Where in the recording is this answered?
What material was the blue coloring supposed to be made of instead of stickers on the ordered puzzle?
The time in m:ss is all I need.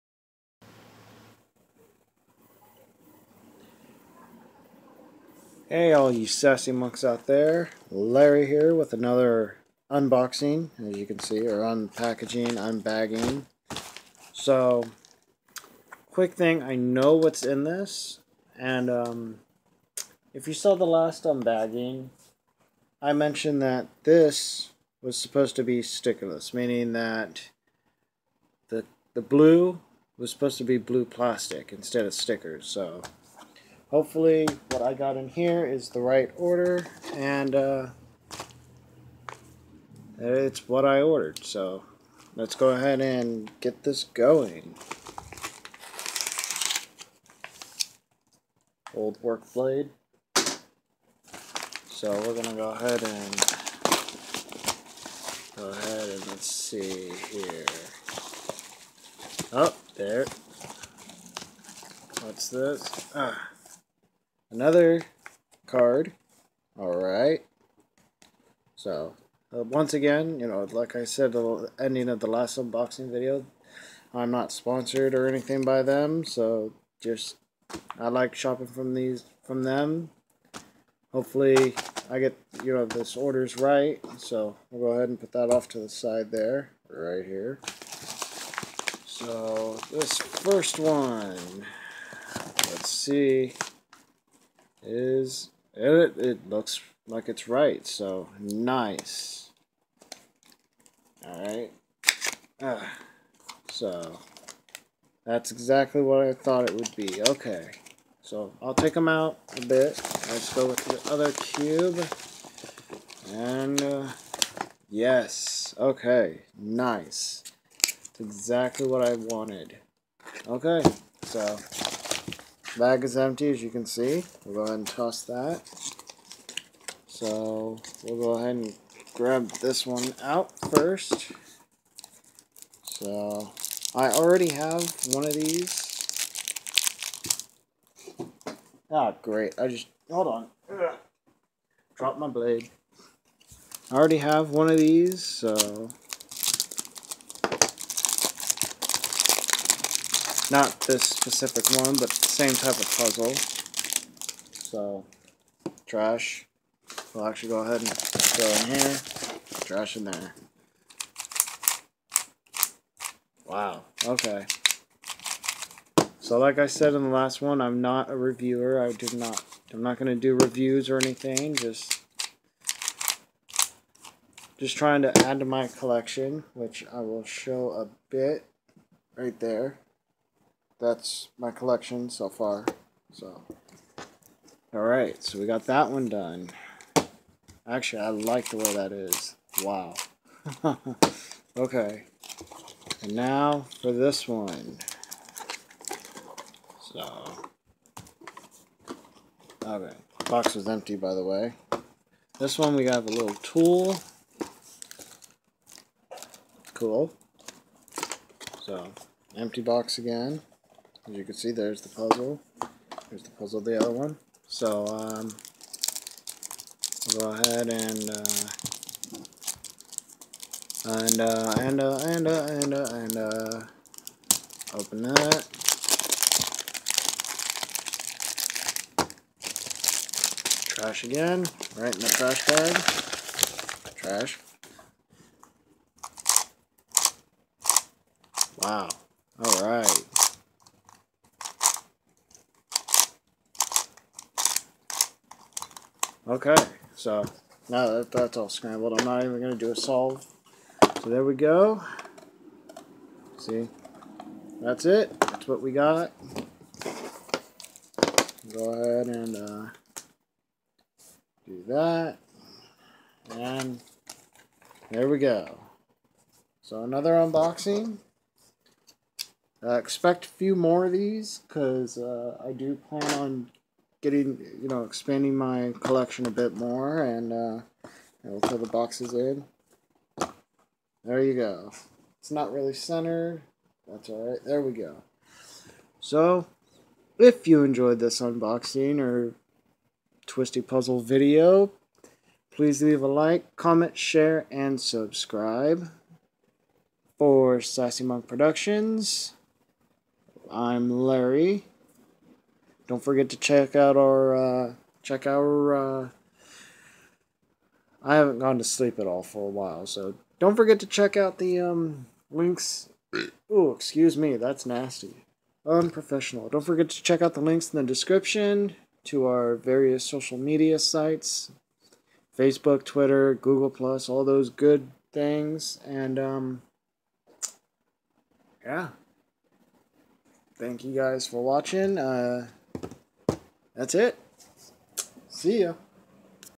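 0:30.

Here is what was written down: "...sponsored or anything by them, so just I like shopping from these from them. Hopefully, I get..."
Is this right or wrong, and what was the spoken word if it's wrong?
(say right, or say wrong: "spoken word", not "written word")
right.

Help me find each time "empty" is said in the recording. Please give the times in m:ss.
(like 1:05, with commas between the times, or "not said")
2:03, 3:20, 3:29.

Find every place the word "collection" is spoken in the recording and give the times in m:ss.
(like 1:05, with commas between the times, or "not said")
2:55, 3:01, 4:35.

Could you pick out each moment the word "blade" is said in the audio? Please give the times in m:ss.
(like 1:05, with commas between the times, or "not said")
0:49, 2:22.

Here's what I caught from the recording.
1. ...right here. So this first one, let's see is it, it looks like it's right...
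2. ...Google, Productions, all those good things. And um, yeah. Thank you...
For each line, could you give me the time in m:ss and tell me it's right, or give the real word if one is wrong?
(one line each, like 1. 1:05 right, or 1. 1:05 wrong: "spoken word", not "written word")
1. 1:26 right
2. 5:23 wrong: "Plus", not "Productions".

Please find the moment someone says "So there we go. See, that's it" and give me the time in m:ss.
4:11.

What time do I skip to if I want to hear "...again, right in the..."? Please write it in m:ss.
3:51.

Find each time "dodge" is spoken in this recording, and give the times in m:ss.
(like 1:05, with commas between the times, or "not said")
not said.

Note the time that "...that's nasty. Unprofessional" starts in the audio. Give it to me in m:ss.
5:14.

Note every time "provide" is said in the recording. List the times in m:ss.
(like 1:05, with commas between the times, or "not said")
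not said.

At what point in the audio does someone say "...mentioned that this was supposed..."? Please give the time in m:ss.
0:23.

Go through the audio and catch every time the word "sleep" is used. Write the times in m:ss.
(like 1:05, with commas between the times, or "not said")
5:08.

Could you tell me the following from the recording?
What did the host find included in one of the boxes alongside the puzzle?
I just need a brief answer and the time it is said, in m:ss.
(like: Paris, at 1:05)
a little tool, at 3:23.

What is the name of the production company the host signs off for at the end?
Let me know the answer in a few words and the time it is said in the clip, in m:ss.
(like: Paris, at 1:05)
Sassy Monk Productions, at 4:57.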